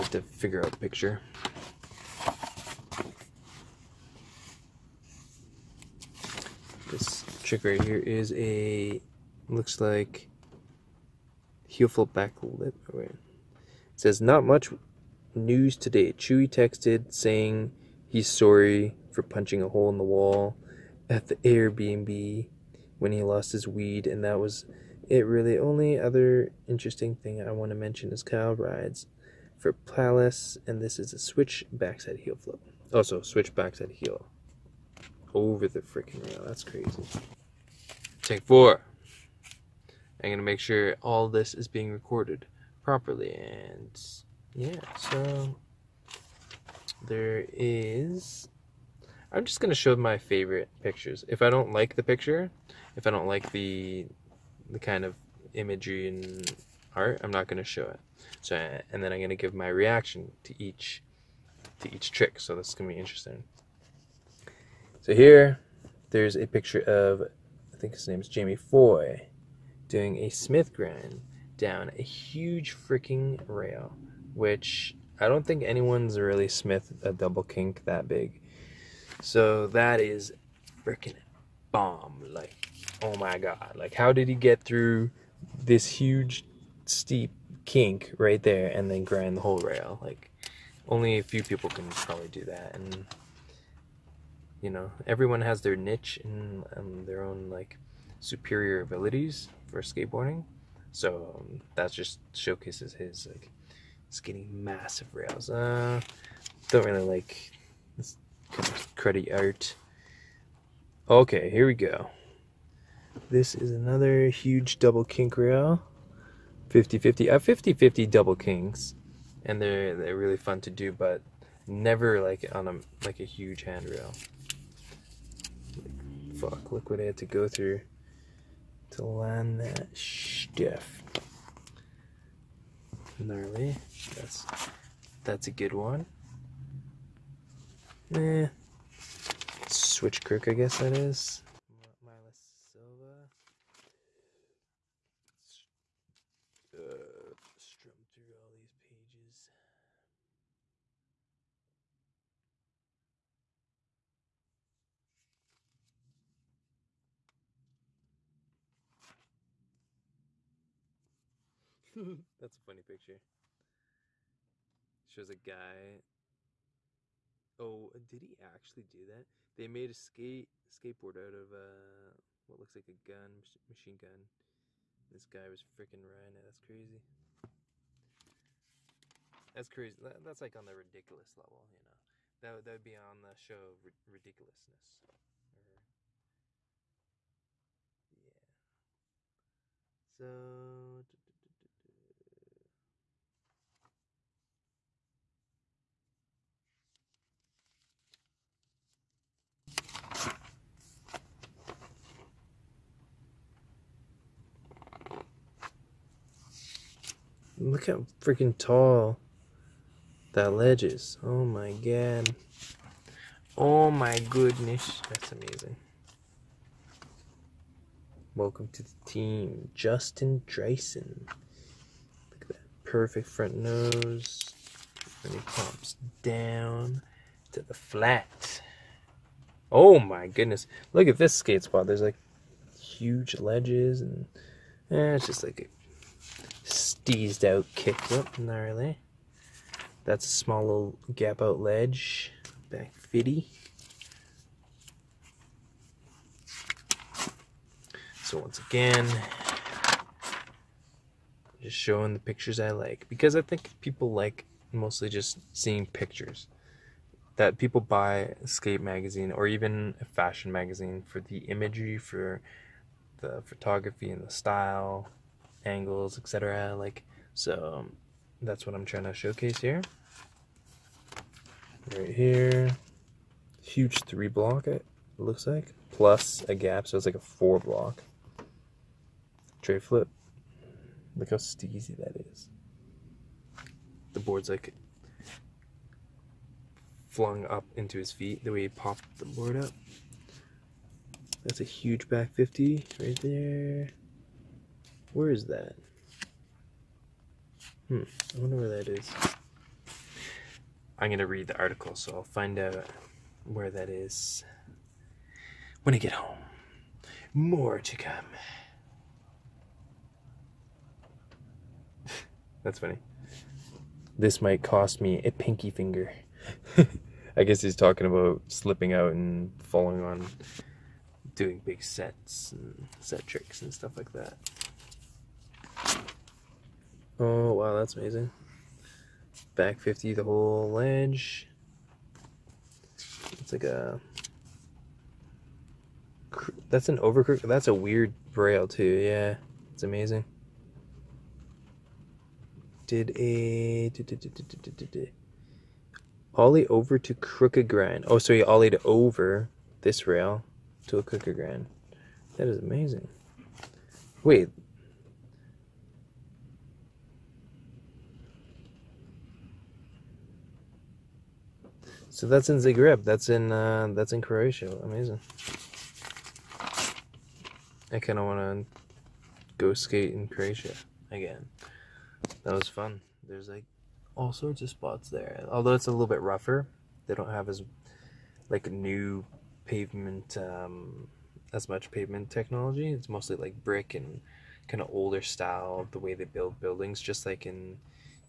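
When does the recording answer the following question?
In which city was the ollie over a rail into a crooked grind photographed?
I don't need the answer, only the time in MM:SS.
06:02.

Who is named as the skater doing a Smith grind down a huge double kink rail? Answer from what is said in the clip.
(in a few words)
Jamie Foy.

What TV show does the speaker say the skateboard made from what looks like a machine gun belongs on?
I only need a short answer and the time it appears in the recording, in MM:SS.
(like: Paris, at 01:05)
Ridiculousness, at 03:04.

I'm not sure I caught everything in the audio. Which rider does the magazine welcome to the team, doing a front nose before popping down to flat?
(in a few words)
Justin Dryson.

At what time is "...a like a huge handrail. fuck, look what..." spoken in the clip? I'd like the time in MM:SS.
02:02.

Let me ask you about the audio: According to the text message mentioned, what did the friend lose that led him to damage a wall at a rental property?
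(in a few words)
his weed.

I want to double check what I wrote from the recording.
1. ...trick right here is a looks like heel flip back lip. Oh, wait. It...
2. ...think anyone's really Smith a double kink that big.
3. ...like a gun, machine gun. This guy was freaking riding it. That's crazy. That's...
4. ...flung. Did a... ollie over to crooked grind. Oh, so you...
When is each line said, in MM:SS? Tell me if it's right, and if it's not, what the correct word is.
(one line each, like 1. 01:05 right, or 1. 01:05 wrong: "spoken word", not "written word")
1. 00:07 right
2. 01:15 right
3. 02:52 right
4. 05:39 wrong: "amazing", not "flung".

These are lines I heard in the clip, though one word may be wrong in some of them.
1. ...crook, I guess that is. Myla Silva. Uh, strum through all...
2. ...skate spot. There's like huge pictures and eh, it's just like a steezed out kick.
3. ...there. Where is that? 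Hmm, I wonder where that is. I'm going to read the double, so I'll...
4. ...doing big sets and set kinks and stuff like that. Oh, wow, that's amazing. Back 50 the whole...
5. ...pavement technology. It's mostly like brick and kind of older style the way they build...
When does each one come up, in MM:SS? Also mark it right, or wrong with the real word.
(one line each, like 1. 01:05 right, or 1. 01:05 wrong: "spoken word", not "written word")
1. 02:20 right
2. 03:51 wrong: "ledges", not "pictures"
3. 04:53 wrong: "article", not "double"
4. 05:21 wrong: "tricks", not "kinks"
5. 06:21 right.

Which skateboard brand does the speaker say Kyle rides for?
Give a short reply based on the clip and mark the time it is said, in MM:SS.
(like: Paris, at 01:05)
Palace, at 00:29.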